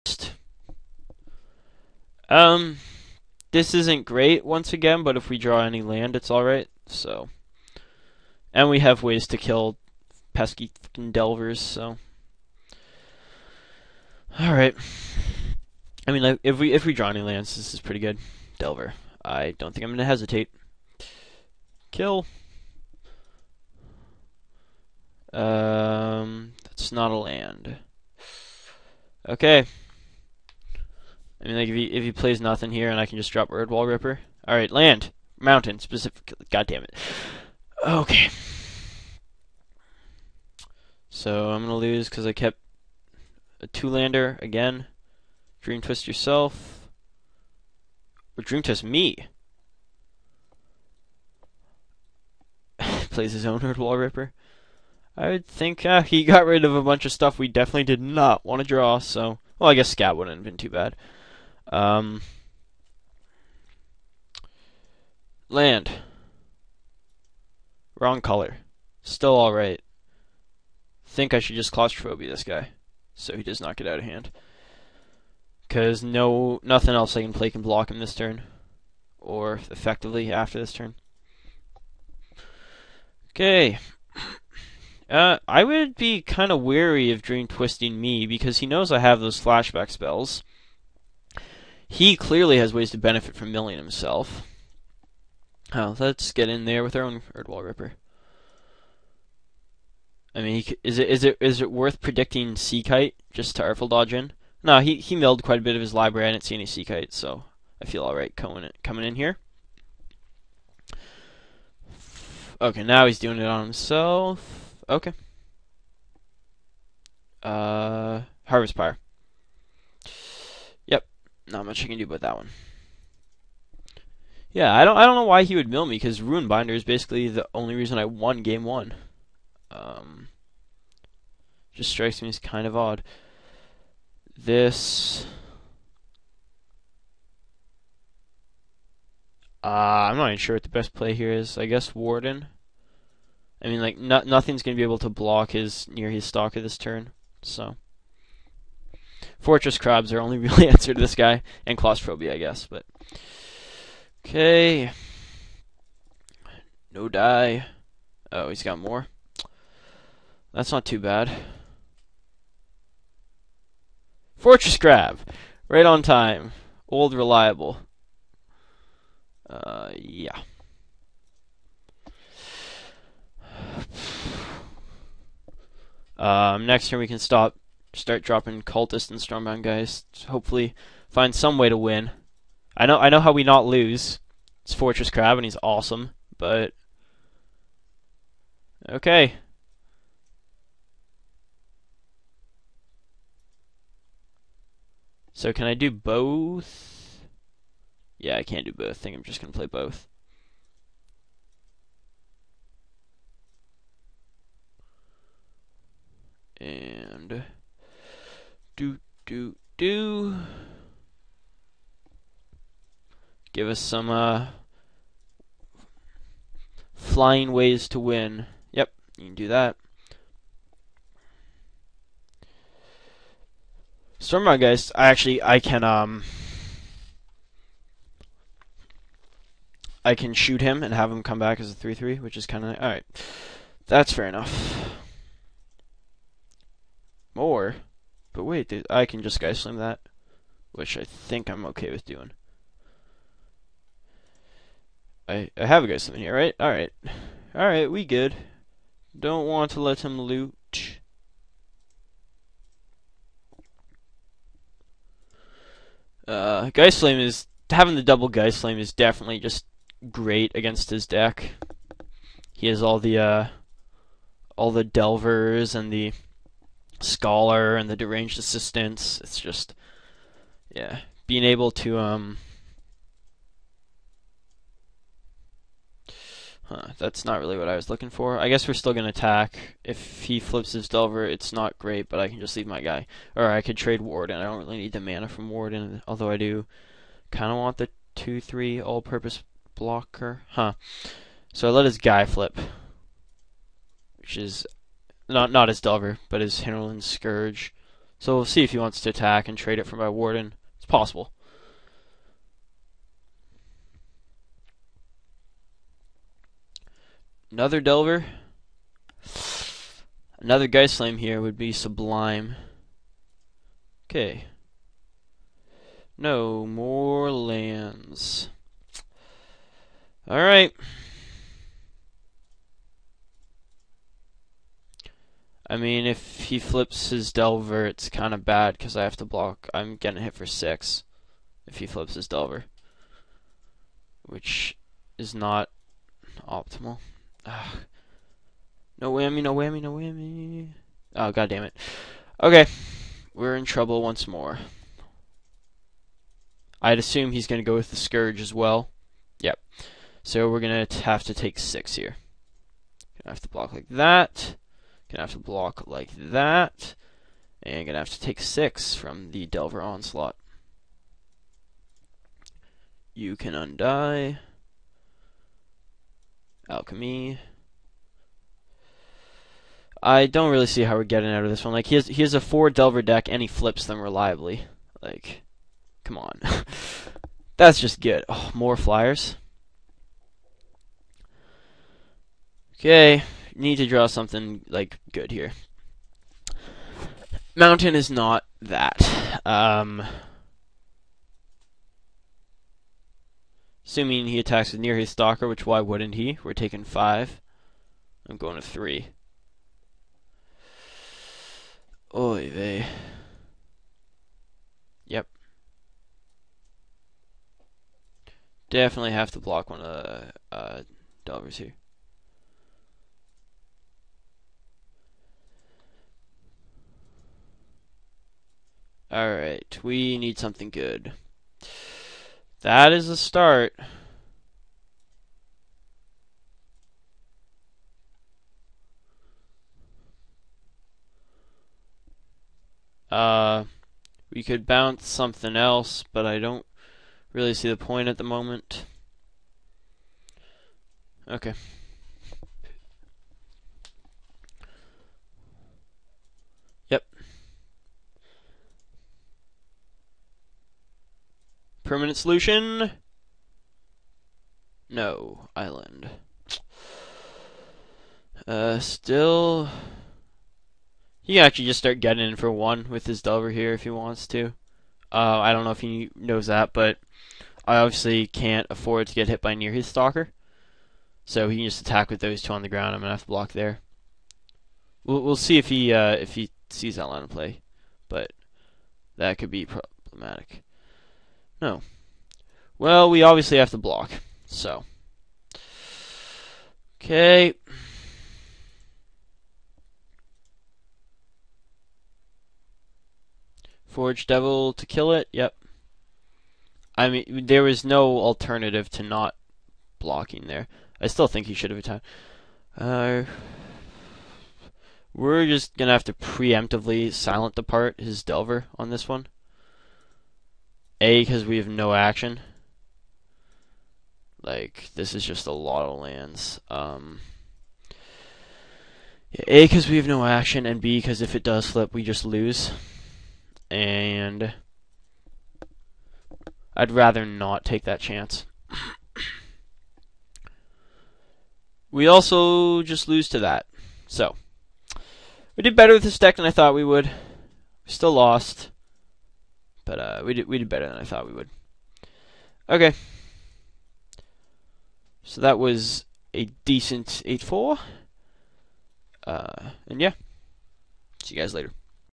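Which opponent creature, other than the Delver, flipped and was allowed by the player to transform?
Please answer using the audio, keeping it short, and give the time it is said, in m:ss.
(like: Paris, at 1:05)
Hinterland Scourge, at 4:56.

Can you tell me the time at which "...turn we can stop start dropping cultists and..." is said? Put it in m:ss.
2:56.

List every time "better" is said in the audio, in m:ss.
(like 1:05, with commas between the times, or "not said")
8:55, 9:00.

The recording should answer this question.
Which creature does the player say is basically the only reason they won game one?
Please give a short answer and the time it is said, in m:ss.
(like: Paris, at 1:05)
Rune Binder, at 2:06.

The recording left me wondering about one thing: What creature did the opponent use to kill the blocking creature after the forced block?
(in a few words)
Forge Devil.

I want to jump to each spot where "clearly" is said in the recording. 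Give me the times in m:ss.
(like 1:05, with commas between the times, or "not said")
1:32.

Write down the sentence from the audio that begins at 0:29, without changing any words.
Okay, I mean, like, if he, if he plays nothing here and I can just drop Erdwal Ripper.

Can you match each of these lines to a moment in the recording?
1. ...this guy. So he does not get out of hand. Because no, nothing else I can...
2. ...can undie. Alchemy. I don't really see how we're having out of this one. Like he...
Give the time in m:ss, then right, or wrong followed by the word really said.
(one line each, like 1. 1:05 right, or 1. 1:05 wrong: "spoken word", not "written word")
1. 1:12 right
2. 6:03 wrong: "getting", not "having".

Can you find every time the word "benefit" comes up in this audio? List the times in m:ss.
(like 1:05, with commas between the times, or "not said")
1:32.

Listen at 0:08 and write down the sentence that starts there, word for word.
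And we have ways to kill pesky delvers, so.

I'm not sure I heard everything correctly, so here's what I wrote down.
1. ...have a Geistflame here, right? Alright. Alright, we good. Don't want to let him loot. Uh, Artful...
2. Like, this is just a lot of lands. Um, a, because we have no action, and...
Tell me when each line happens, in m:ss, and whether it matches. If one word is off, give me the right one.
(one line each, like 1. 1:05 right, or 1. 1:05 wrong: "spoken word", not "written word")
1. 4:05 wrong: "Geistflame", not "Artful"
2. 8:34 right.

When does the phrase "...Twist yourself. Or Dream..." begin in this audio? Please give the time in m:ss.
0:45.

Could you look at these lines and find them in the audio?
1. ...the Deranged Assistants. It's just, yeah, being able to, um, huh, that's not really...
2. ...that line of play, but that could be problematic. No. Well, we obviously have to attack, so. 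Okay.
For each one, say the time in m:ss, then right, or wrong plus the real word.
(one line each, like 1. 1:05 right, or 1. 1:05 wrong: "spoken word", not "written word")
1. 4:27 right
2. 7:56 wrong: "block", not "attack".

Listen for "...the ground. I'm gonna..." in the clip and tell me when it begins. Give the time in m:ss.
7:52.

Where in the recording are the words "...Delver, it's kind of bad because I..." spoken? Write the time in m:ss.
5:27.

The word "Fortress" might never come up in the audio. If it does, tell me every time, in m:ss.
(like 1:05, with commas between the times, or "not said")
2:29, 2:44, 3:04.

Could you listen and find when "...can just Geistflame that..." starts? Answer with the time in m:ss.
3:59.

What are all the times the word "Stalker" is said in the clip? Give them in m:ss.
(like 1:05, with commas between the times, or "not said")
2:26, 6:35, 7:49.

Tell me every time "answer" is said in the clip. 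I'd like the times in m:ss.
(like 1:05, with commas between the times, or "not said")
2:30.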